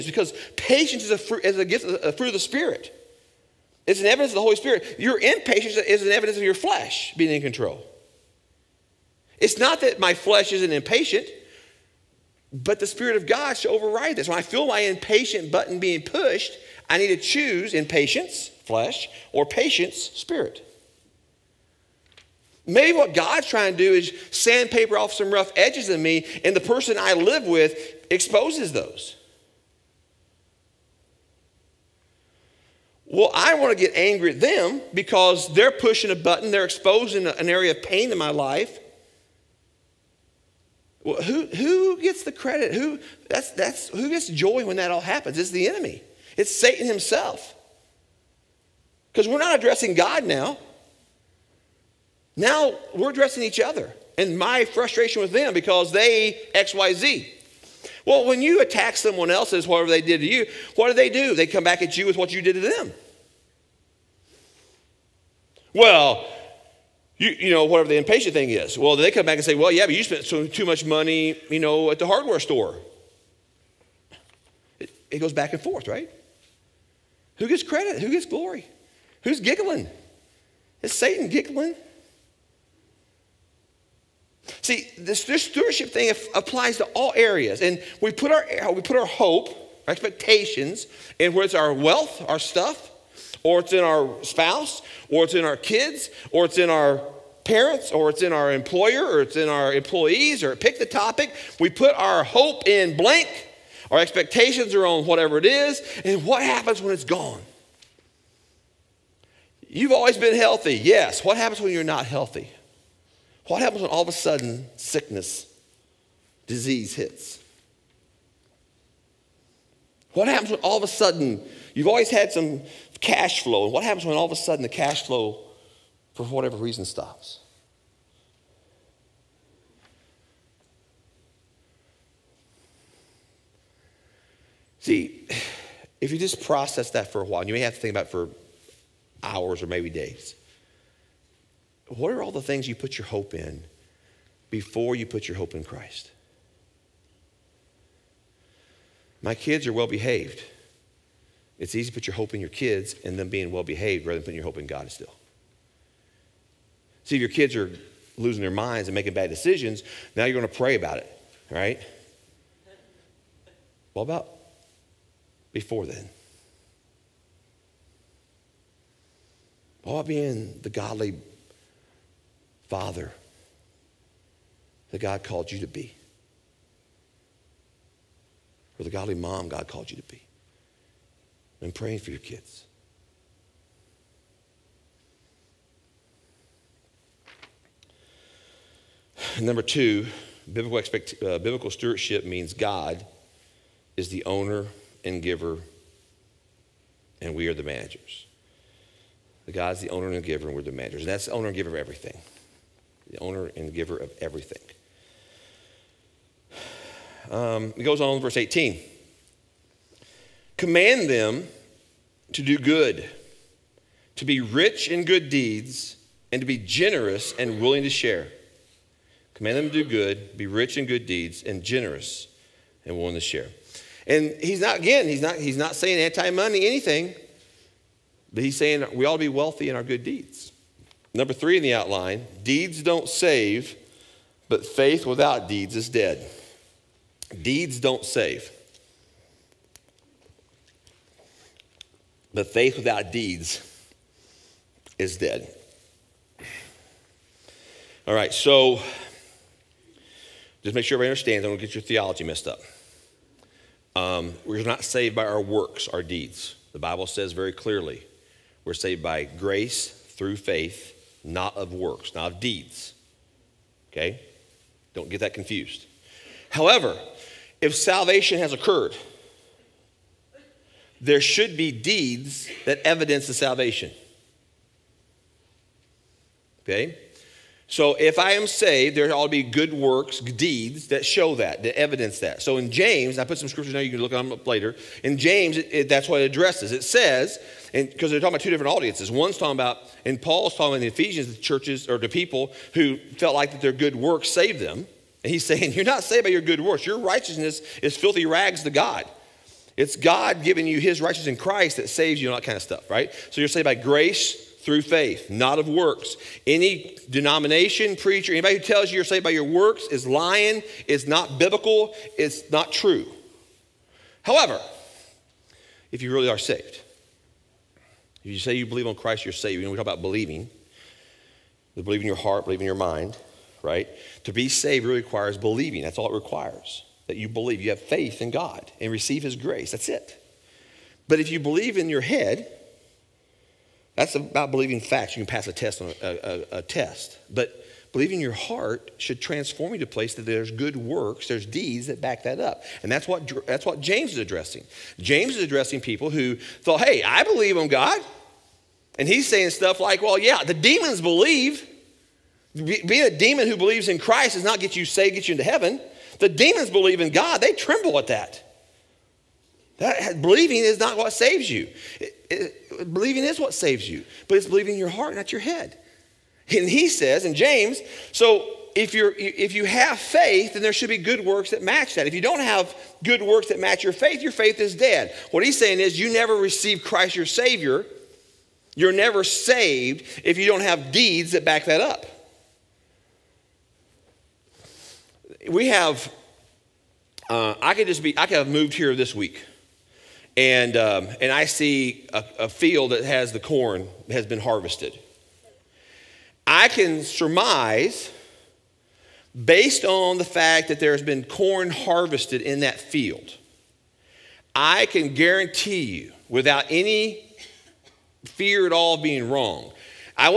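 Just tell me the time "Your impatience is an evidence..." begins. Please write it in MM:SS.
00:04.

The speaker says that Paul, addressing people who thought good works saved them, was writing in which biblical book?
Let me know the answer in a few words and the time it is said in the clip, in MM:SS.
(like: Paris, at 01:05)
Ephesians, at 04:50.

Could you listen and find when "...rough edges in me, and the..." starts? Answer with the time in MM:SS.
00:25.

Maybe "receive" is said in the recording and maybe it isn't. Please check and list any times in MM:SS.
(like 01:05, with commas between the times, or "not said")
05:28, 06:16.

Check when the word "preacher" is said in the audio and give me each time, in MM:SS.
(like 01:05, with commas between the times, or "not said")
05:07.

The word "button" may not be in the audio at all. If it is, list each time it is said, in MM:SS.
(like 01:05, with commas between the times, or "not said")
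00:15, 00:36.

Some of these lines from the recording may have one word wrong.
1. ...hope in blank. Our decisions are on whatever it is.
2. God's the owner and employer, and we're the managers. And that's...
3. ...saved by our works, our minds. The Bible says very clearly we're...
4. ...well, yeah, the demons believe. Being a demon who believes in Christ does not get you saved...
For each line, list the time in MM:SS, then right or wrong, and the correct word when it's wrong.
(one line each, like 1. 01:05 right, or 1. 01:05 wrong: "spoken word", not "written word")
1. 01:42 wrong: "expectations", not "decisions"
2. 03:19 wrong: "giver", not "employer"
3. 04:14 wrong: "deeds", not "minds"
4. 05:50 right.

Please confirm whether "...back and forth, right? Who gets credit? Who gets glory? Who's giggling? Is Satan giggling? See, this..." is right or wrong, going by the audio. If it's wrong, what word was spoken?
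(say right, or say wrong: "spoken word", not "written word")
right.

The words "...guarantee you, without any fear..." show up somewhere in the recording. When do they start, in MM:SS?
06:45.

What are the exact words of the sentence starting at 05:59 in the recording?
That believing is not what saves you.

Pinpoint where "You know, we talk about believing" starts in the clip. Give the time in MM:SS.
05:19.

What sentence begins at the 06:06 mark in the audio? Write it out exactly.
And he says in James, so if you if you have faith, then there should be good works that match that.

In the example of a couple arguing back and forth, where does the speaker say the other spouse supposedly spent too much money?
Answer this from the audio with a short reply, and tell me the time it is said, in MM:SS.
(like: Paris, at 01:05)
the hardware store, at 01:11.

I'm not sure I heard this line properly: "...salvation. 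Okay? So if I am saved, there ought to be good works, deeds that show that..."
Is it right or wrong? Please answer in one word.
right.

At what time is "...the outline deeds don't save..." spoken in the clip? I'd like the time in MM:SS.
03:51.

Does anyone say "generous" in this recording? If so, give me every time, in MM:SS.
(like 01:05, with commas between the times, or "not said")
03:36, 03:41.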